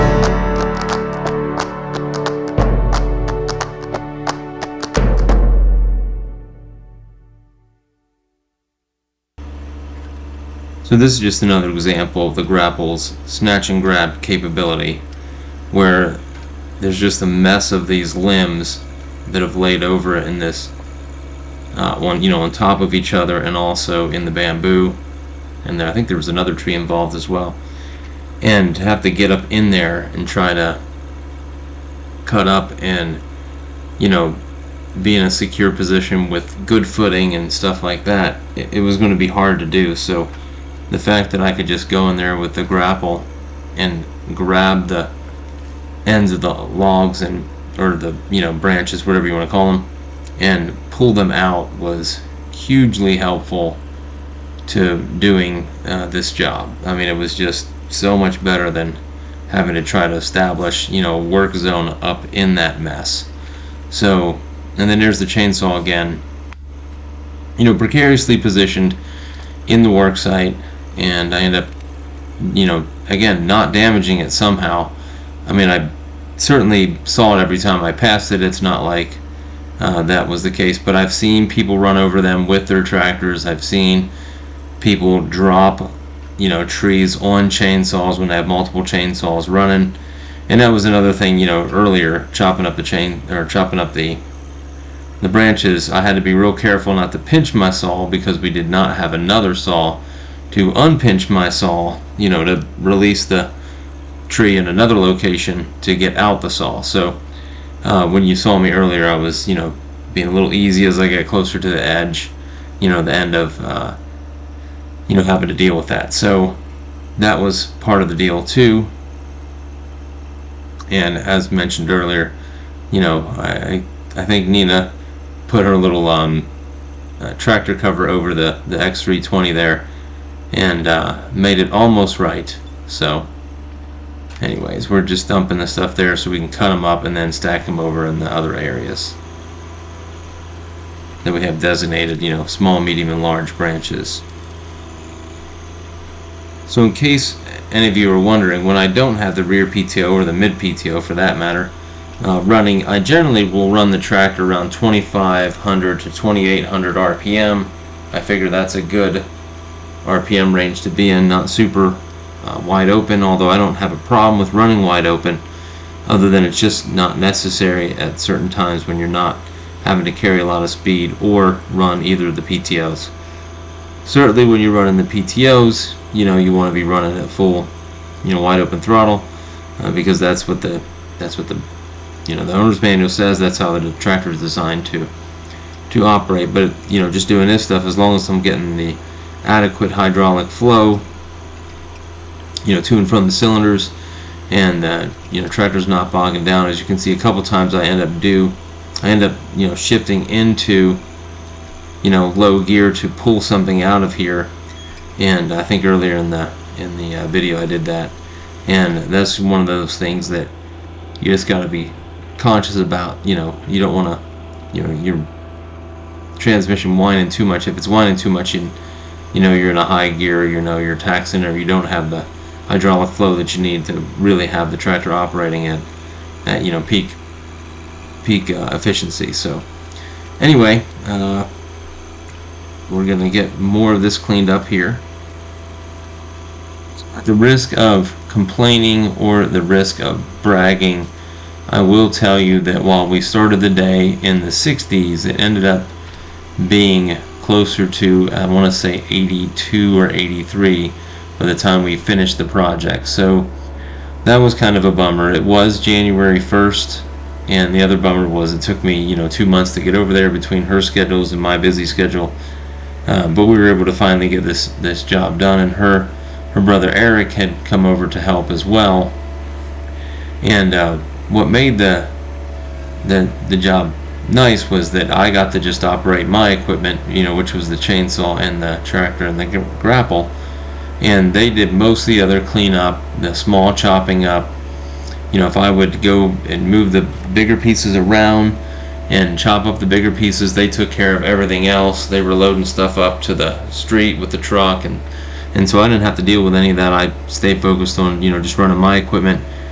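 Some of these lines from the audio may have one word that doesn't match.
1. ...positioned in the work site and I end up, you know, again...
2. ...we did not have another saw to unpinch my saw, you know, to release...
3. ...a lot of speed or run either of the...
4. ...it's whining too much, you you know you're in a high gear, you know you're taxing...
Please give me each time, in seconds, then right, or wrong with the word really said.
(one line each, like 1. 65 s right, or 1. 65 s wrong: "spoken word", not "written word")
1. 68 s right
2. 98 s right
3. 170 s right
4. 217 s right.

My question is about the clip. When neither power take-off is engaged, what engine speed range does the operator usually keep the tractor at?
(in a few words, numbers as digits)
2500 to 2800 RPM.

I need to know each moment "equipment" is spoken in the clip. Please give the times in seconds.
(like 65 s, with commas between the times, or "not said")
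276 s, 298 s.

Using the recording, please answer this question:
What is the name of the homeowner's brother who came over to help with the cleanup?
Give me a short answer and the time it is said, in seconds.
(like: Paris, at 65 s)
Eric, at 266 s.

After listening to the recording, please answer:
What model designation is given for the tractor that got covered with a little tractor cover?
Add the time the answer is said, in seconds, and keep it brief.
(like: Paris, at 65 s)
X320, at 128 s.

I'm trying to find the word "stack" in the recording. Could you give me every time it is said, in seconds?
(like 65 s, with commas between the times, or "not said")
137 s.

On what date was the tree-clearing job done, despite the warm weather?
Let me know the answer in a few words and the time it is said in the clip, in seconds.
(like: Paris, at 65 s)
January 1st, at 255 s.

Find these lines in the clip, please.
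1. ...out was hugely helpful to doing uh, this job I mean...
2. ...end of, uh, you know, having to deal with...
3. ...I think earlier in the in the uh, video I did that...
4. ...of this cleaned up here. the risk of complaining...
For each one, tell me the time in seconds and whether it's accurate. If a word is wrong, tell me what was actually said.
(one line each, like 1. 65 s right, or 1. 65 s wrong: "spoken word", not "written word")
1. 51 s right
2. 113 s right
3. 205 s right
4. 233 s right.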